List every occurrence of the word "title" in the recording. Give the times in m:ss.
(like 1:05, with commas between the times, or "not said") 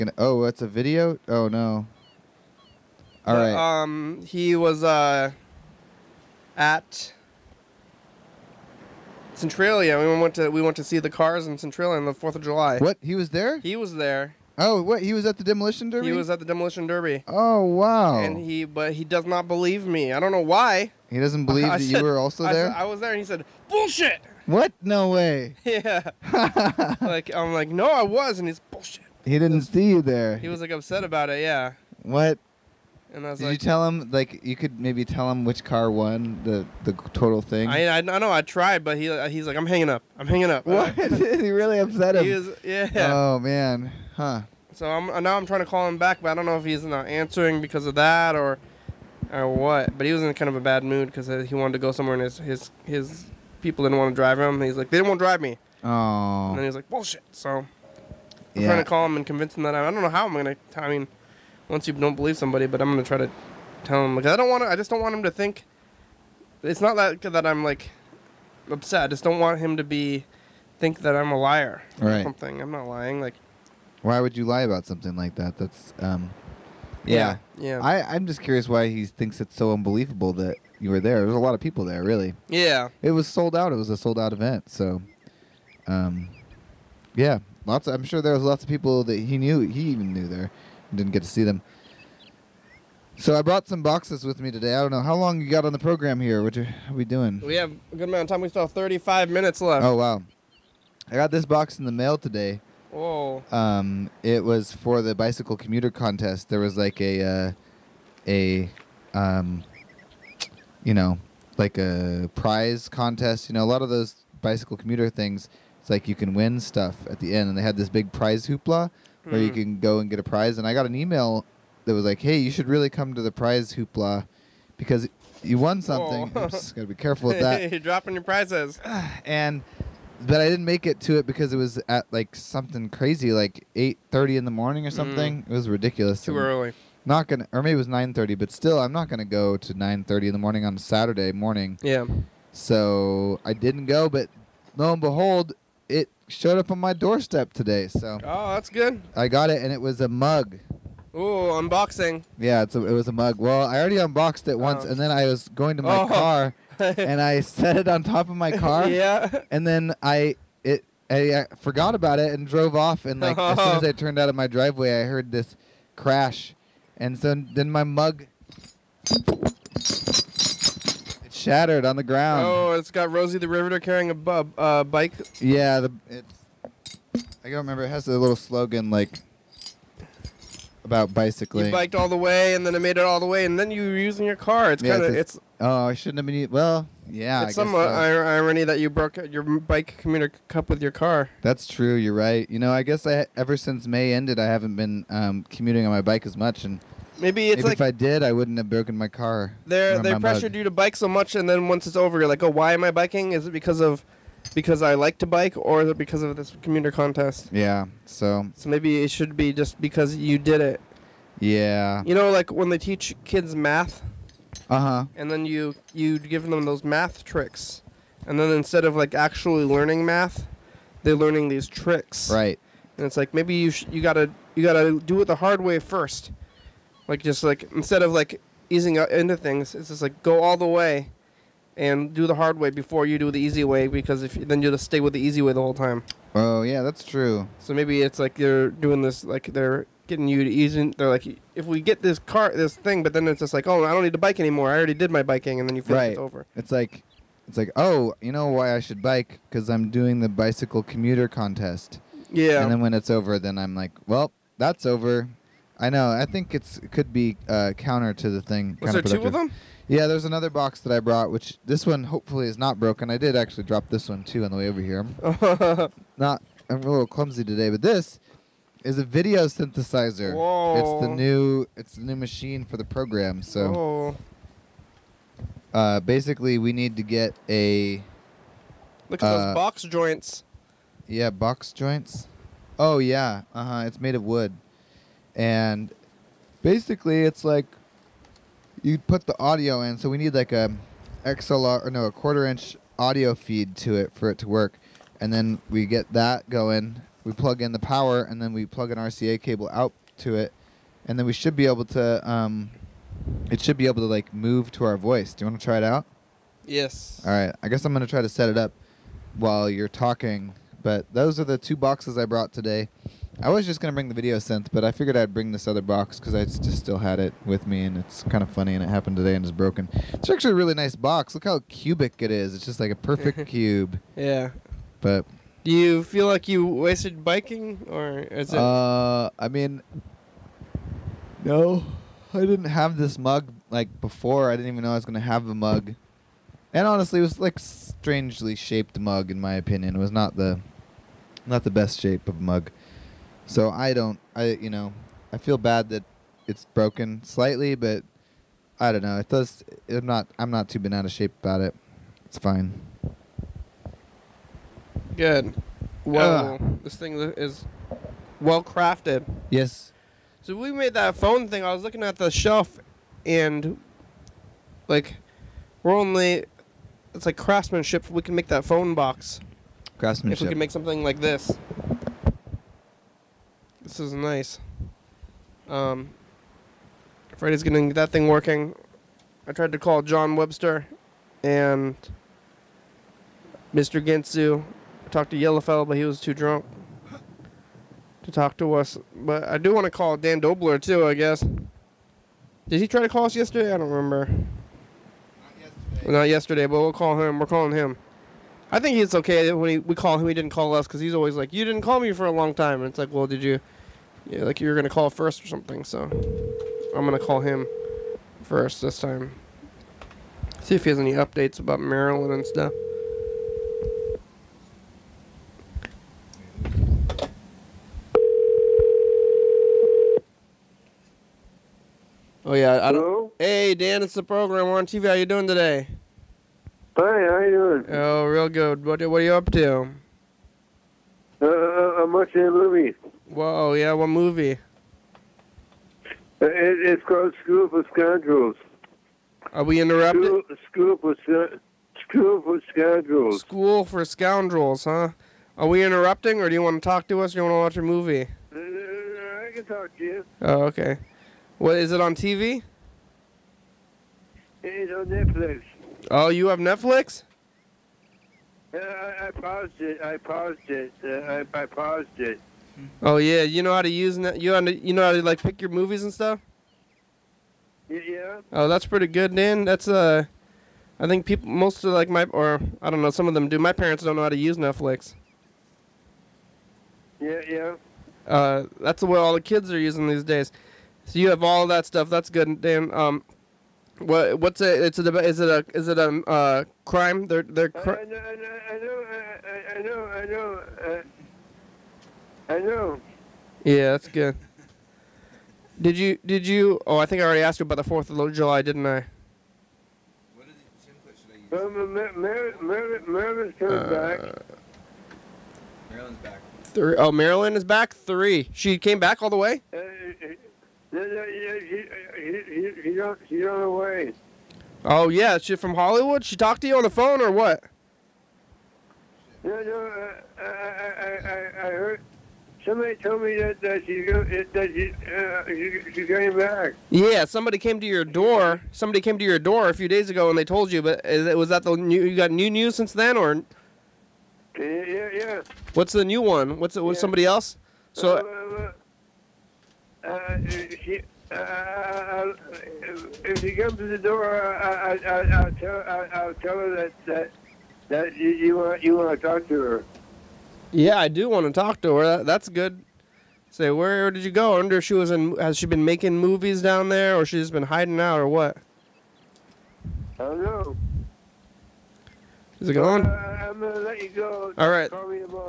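not said.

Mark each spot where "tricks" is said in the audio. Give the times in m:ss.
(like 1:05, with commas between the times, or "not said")
3:37, 3:41.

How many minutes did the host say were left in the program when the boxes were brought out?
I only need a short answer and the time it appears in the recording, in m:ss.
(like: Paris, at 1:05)
35, at 1:38.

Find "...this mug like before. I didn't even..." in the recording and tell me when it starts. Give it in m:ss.
5:32.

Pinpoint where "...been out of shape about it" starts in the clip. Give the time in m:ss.
5:50.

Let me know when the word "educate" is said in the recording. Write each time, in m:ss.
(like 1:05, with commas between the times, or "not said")
not said.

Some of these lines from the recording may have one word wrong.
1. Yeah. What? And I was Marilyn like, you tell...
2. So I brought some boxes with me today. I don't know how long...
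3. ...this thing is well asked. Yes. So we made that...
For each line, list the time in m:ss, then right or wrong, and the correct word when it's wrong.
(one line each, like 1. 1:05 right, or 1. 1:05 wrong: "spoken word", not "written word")
1. 0:31 wrong: "Did", not "Marilyn"
2. 1:33 right
3. 5:56 wrong: "crafted", not "asked".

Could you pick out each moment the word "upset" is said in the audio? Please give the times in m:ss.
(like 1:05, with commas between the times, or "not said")
0:30, 0:41, 1:08.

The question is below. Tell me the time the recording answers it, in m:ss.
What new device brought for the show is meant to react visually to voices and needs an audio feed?
4:29.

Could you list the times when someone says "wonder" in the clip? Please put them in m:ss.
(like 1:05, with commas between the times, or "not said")
9:14.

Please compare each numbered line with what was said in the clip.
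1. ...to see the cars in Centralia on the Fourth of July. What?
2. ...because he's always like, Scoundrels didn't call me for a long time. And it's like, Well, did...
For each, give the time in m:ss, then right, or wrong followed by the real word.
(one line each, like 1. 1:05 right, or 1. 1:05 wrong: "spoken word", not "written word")
1. 0:10 right
2. 6:40 wrong: "You", not "Scoundrels".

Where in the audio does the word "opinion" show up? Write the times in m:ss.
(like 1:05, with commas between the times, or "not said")
5:39.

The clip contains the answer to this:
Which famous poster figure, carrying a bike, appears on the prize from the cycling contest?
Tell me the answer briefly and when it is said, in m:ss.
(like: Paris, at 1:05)
Rosie the Riveter, at 2:53.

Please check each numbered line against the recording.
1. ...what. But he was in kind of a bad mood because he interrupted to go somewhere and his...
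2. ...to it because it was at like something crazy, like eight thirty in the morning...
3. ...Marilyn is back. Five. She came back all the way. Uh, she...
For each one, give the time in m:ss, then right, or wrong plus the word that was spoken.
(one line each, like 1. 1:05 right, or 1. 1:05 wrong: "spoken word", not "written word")
1. 0:49 wrong: "wanted", not "interrupted"
2. 2:11 right
3. 8:27 wrong: "Three", not "Five".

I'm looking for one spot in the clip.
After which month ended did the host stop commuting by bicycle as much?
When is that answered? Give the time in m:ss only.
3:13.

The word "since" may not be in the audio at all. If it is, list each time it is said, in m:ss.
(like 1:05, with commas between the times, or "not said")
3:13, 8:52.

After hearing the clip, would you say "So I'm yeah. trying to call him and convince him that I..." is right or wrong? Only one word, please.
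right.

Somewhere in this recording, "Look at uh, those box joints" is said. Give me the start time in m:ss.
4:39.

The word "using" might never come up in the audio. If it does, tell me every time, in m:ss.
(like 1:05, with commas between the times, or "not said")
3:03, 7:59.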